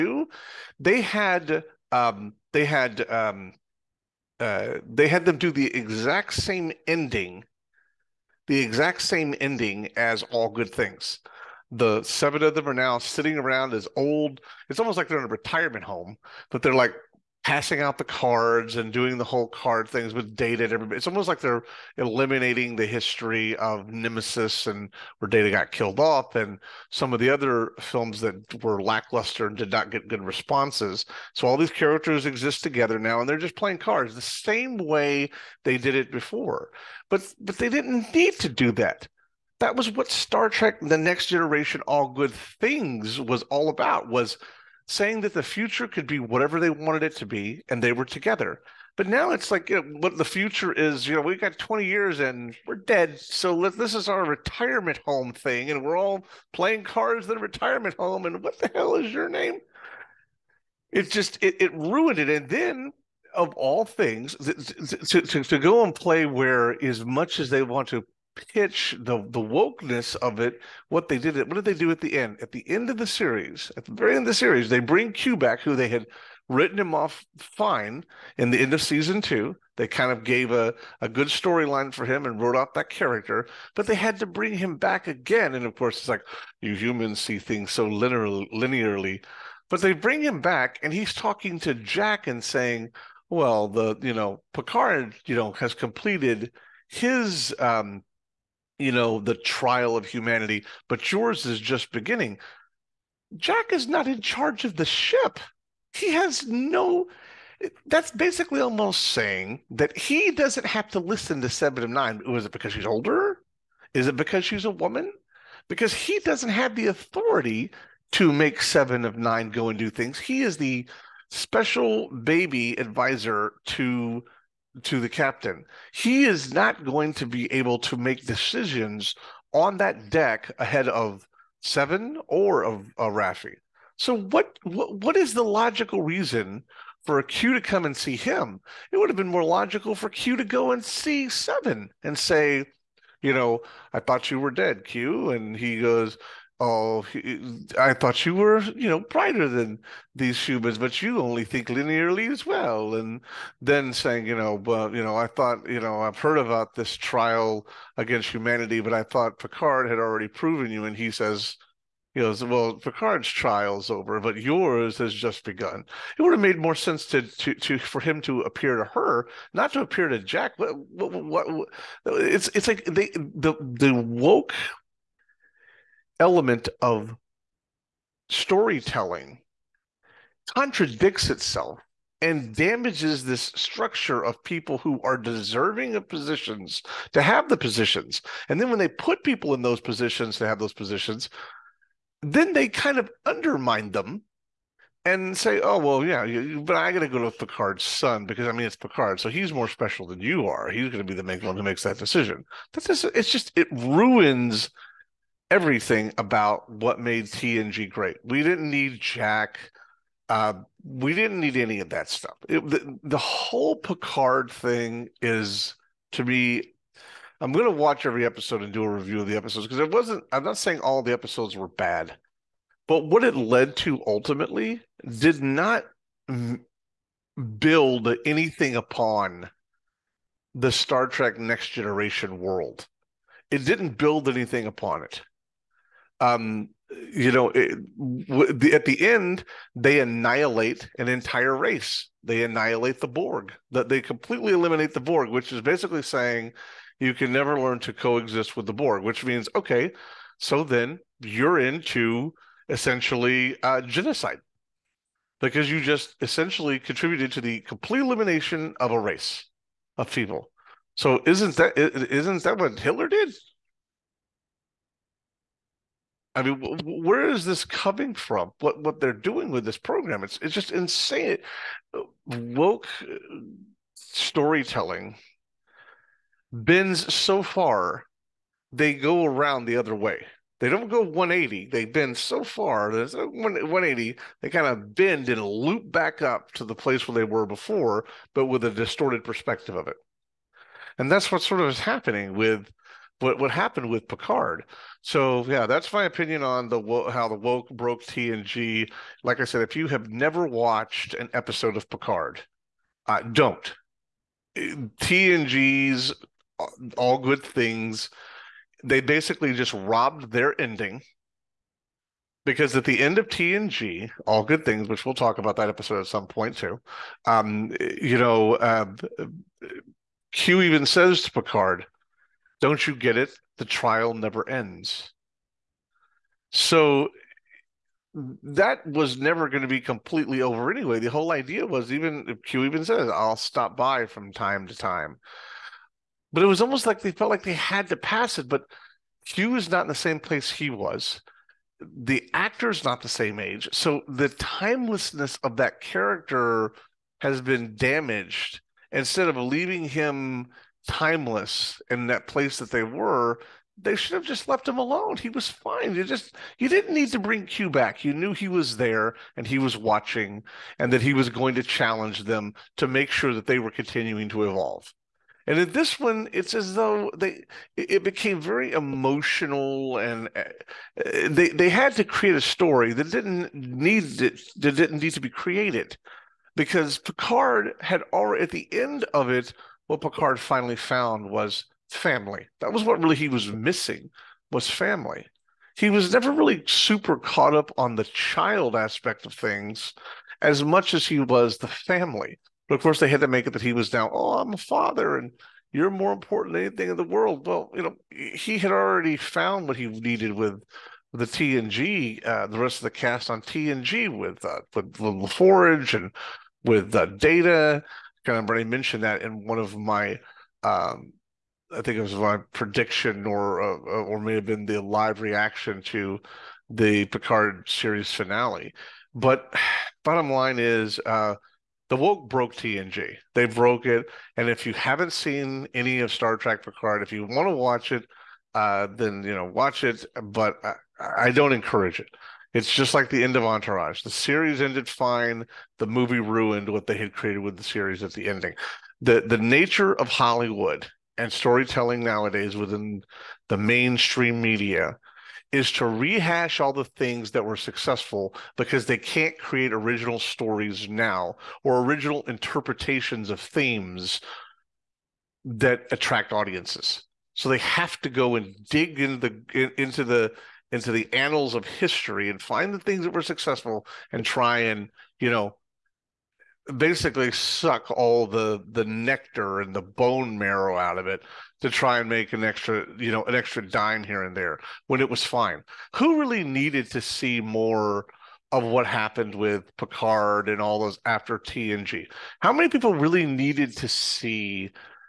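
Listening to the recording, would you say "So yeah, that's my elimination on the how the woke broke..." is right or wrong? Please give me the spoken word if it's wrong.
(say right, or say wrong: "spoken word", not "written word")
wrong: "opinion", not "elimination".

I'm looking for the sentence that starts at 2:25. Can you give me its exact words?
And he goes, oh, I thought you were, you know, brighter than these humans, but you only think linearly as well.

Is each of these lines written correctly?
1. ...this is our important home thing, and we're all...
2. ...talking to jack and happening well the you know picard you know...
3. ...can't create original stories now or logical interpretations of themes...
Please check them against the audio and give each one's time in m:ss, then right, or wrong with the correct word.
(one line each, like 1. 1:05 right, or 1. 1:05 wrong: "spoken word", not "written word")
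1. 0:53 wrong: "retirement", not "important"
2. 1:31 wrong: "saying", not "happening"
3. 7:28 wrong: "original", not "logical".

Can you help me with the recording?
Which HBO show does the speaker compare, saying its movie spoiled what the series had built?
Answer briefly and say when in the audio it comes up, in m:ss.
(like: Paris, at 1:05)
Entourage, at 7:13.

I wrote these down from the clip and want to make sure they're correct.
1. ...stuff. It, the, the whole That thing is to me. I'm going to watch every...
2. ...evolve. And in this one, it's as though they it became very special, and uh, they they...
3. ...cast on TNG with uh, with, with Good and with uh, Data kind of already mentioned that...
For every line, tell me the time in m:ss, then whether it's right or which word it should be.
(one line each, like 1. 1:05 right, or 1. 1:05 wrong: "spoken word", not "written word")
1. 3:32 wrong: "Picard", not "That"
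2. 6:04 wrong: "emotional", not "special"
3. 6:42 wrong: "LaForge", not "Good".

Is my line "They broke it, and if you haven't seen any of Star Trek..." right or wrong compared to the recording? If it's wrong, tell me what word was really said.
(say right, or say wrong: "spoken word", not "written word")
right.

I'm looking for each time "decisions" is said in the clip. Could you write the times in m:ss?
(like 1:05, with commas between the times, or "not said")
2:08, 3:21.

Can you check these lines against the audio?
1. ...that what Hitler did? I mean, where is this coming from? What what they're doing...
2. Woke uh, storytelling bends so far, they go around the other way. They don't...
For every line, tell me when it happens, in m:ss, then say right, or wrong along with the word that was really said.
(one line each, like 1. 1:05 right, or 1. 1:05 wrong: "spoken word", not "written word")
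1. 4:22 right
2. 4:32 right.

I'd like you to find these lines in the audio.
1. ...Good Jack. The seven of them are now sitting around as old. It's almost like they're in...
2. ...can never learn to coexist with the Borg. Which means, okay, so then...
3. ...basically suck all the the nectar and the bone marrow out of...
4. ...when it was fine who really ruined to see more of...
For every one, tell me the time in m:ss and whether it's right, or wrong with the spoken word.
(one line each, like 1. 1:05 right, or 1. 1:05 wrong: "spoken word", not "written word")
1. 0:10 wrong: "Things", not "Jack"
2. 4:07 right
3. 7:46 right
4. 7:54 wrong: "needed", not "ruined".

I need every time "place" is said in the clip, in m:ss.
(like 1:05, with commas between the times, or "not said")
4:46, 5:40, 5:52.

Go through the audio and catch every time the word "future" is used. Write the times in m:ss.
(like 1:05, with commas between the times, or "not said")
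0:45, 0:50.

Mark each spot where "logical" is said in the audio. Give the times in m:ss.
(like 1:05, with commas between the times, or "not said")
2:15, 2:19.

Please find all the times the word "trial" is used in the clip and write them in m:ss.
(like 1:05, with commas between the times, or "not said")
1:39, 2:36, 2:43, 5:23.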